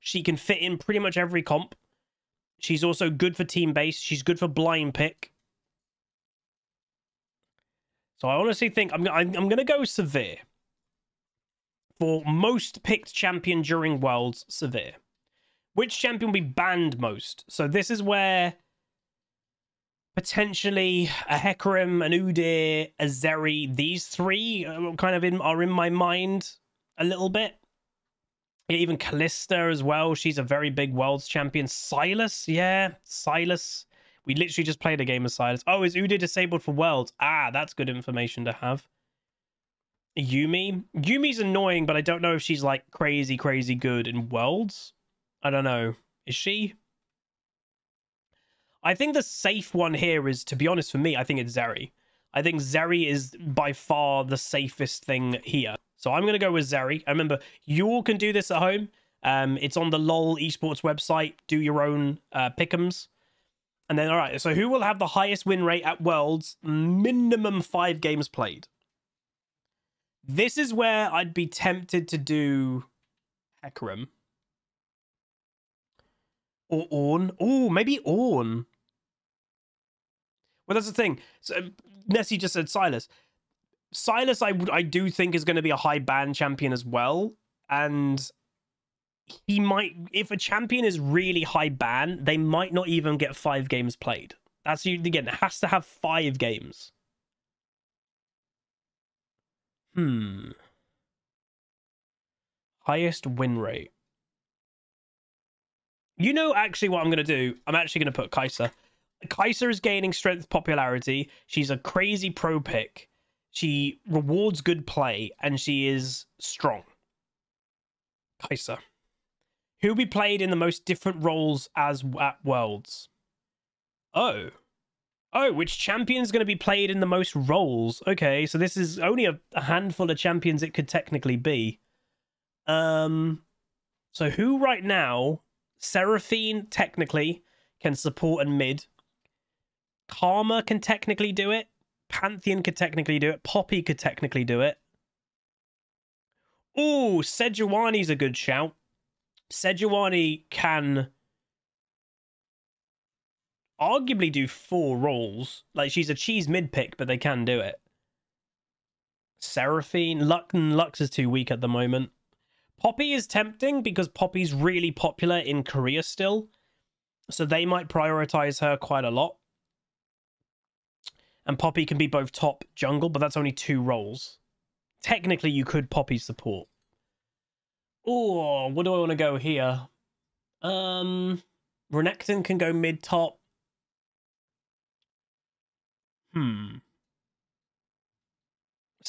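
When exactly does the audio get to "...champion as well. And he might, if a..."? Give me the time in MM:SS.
01:26.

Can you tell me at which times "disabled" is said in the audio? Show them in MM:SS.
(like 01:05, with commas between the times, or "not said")
00:36.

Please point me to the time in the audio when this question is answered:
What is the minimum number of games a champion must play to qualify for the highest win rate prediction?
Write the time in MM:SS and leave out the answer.
01:06.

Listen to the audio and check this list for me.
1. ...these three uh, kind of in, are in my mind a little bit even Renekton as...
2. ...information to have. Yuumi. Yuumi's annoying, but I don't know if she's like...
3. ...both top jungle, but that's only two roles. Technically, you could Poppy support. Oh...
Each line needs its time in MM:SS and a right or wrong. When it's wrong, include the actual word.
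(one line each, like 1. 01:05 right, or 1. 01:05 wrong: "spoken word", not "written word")
1. 00:23 wrong: "Kalista", not "Renekton"
2. 00:37 right
3. 02:52 right.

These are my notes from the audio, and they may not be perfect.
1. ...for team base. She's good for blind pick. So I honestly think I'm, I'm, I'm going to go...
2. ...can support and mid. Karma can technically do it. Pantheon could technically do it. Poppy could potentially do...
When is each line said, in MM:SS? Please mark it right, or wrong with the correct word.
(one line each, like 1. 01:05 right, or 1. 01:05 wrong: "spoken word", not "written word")
1. 00:03 right
2. 02:17 wrong: "technically", not "potentially".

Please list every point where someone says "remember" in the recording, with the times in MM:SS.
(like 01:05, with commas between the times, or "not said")
00:57.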